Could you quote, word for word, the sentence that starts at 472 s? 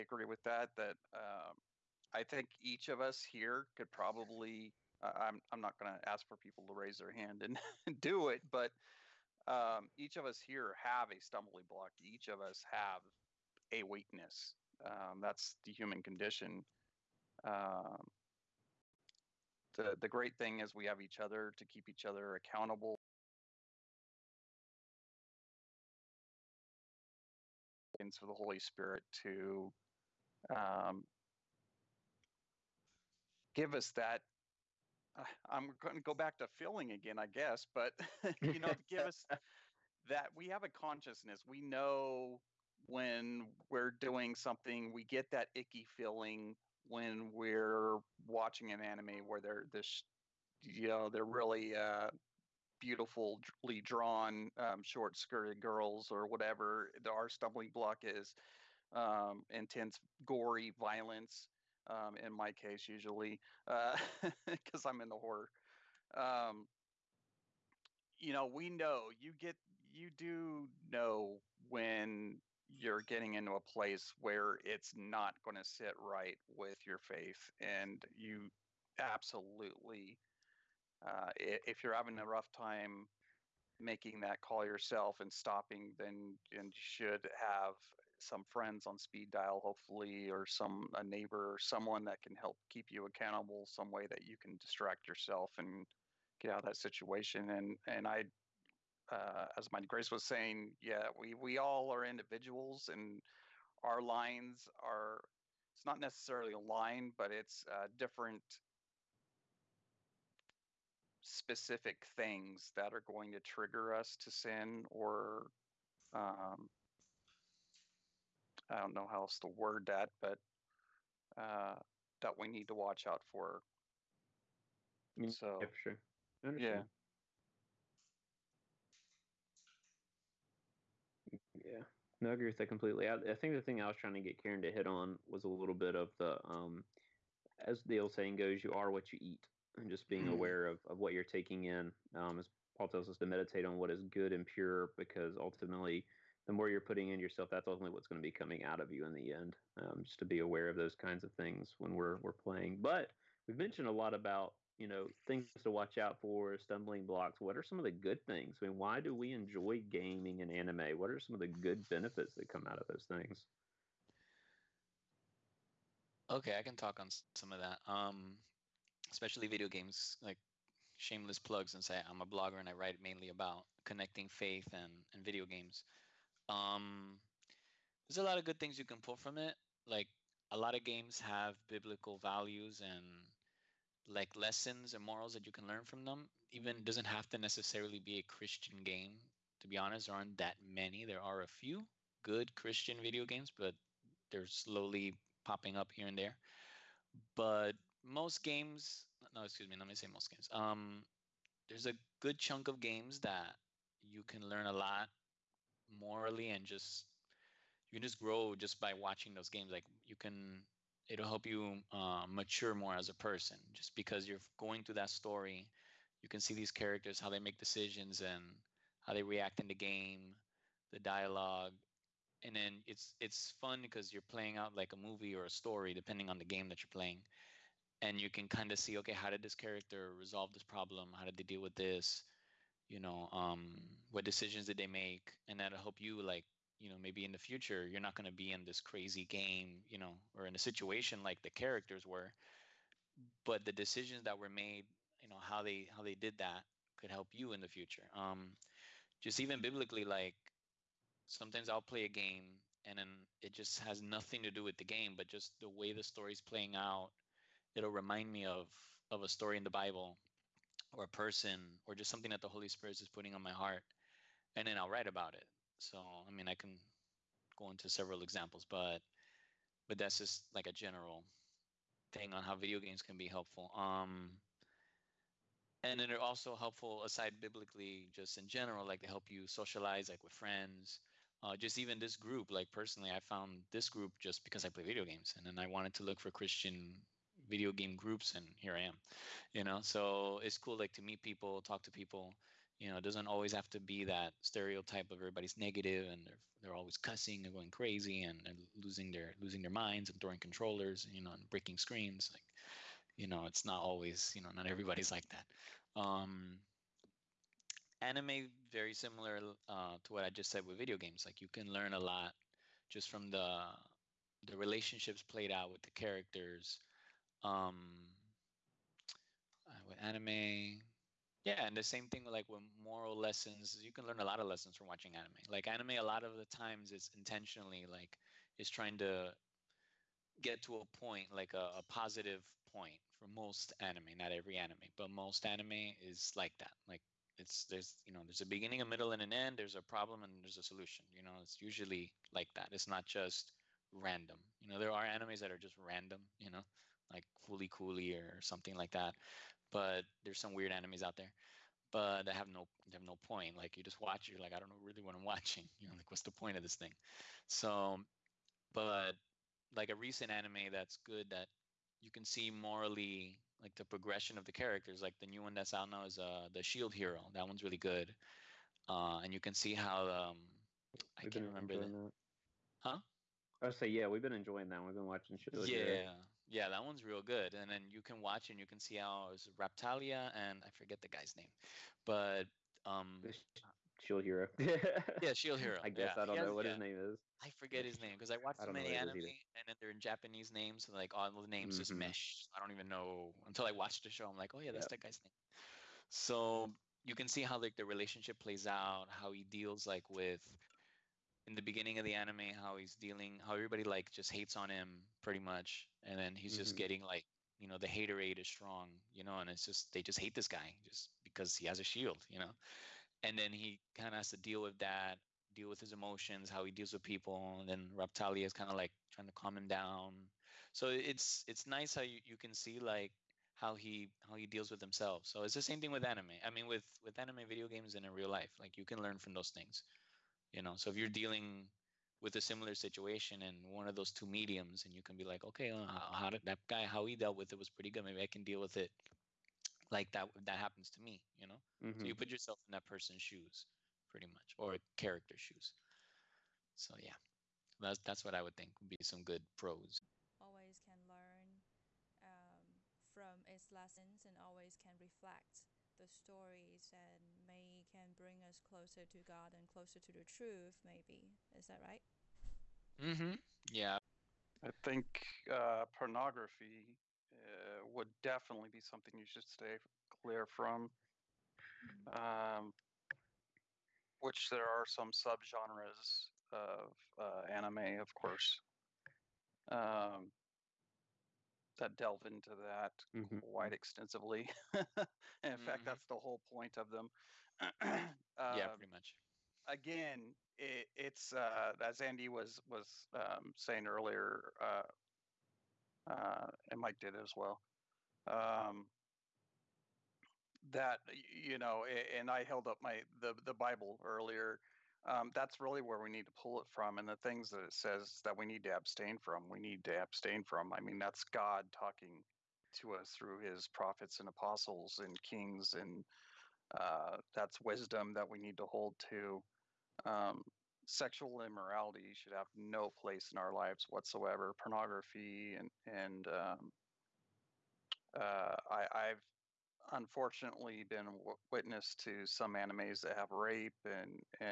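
Um, which there are some subgenres of uh, anime, of course.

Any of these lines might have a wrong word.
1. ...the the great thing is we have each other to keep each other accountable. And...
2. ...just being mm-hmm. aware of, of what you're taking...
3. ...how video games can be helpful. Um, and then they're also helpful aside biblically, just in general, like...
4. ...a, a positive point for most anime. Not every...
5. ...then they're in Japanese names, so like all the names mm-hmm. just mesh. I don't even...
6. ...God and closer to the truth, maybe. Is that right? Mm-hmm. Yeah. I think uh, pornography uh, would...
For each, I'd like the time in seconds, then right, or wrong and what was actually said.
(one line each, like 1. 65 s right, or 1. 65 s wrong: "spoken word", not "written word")
1. 19 s right
2. 139 s right
3. 272 s right
4. 331 s right
5. 389 s right
6. 459 s right.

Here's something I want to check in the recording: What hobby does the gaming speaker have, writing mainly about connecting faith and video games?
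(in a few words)
Blogger.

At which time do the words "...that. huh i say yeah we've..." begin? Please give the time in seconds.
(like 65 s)
371 s.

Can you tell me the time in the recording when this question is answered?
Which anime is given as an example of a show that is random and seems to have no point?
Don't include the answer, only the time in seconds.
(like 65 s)
347 s.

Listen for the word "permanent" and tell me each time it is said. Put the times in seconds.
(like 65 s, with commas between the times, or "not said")
not said.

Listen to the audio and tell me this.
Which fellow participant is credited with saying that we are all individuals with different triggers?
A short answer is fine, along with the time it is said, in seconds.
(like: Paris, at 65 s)
Mighty Grace, at 99 s.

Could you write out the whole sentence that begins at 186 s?
Even doesn't have to necessarily be a Christian game.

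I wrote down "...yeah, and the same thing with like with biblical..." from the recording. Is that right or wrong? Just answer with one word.
wrong.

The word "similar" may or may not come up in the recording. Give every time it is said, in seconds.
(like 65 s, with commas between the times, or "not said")
308 s, 432 s.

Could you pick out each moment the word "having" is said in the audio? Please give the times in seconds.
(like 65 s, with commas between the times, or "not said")
81 s.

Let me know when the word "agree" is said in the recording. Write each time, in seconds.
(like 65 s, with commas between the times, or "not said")
132 s.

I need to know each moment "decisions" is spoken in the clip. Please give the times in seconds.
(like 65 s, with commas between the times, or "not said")
217 s, 234 s, 243 s.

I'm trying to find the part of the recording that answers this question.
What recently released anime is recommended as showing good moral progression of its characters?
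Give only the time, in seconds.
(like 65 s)
366 s.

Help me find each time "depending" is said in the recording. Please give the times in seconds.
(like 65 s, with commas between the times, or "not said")
225 s.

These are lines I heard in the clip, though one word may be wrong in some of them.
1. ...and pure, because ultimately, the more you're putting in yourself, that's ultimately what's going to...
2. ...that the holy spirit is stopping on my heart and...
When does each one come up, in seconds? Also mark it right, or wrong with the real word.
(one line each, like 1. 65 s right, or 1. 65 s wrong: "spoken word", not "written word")
1. 144 s right
2. 262 s wrong: "putting", not "stopping".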